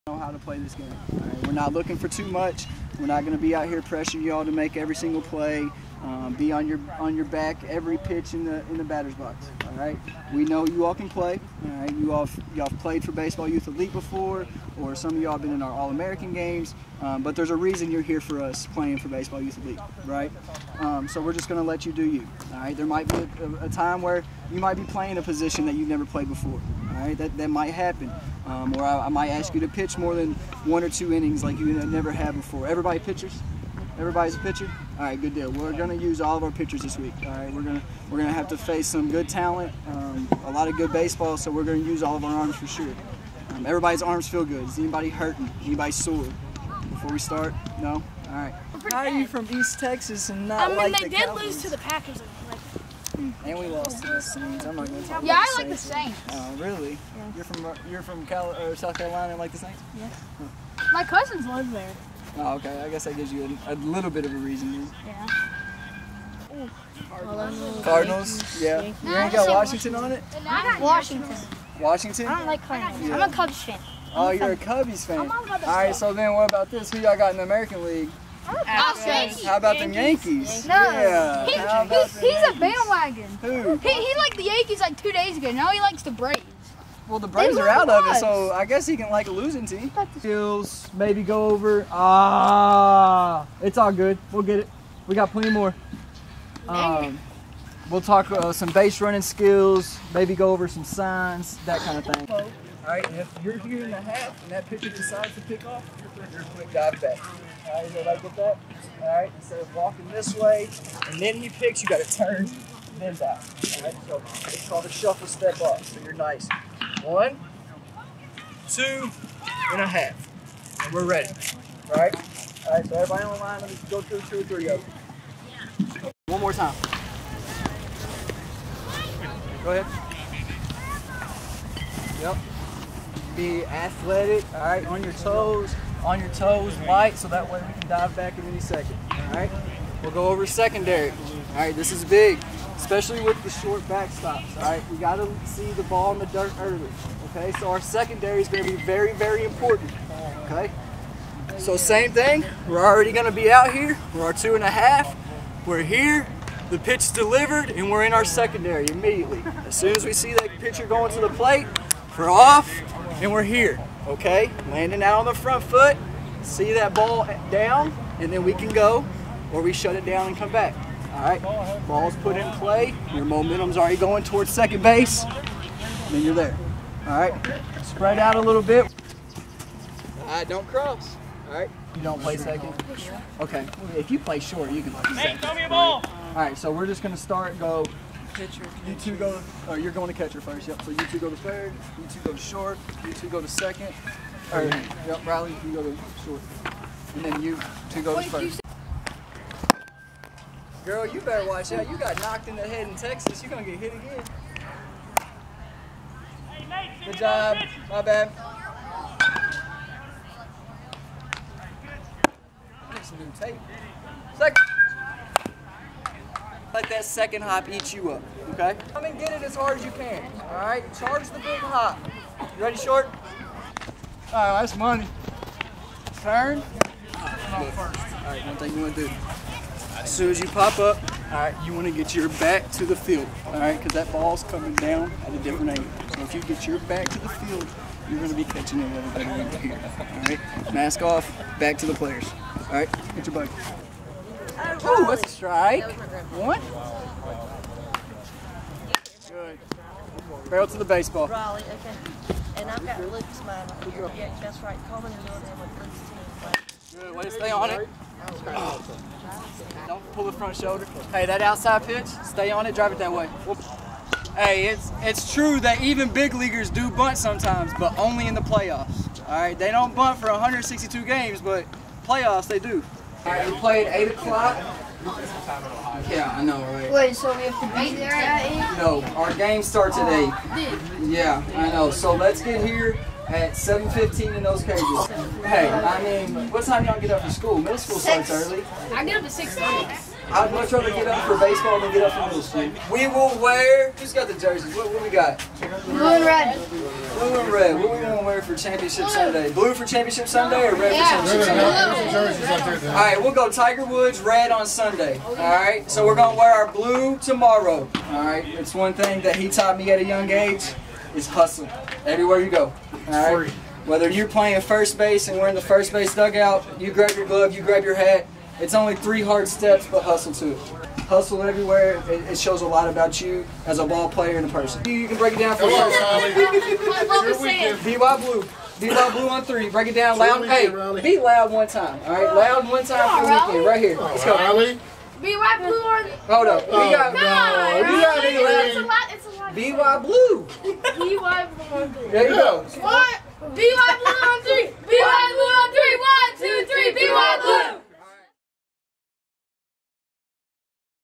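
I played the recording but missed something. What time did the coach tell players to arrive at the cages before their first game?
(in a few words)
7:15.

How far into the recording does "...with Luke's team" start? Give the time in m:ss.
4:15.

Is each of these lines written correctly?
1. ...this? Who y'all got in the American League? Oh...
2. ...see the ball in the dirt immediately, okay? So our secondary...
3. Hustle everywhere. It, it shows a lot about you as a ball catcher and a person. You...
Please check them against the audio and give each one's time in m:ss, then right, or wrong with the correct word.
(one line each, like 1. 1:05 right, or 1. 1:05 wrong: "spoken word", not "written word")
1. 1:16 right
2. 2:25 wrong: "early", not "immediately"
3. 5:21 wrong: "player", not "catcher".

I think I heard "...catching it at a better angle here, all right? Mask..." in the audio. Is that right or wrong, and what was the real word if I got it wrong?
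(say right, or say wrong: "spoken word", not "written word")
right.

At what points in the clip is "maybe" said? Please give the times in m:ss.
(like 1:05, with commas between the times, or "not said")
1:30, 1:40.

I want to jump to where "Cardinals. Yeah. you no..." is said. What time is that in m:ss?
1:07.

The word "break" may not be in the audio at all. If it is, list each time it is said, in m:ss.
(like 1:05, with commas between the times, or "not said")
5:25, 5:29.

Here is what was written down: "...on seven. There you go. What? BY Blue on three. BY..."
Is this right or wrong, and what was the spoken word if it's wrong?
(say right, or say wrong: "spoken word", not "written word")
wrong: "three", not "seven".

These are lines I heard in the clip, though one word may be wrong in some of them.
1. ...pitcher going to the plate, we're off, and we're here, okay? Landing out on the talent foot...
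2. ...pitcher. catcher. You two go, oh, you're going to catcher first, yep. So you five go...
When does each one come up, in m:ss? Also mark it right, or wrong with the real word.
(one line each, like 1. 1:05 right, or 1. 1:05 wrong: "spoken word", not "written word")
1. 2:40 wrong: "front", not "talent"
2. 3:08 wrong: "two", not "five".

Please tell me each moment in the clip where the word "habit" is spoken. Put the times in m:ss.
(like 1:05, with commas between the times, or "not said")
not said.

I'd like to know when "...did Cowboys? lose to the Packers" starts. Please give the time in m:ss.
0:51.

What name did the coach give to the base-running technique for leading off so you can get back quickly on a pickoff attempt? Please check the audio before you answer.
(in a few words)
Shuffle step.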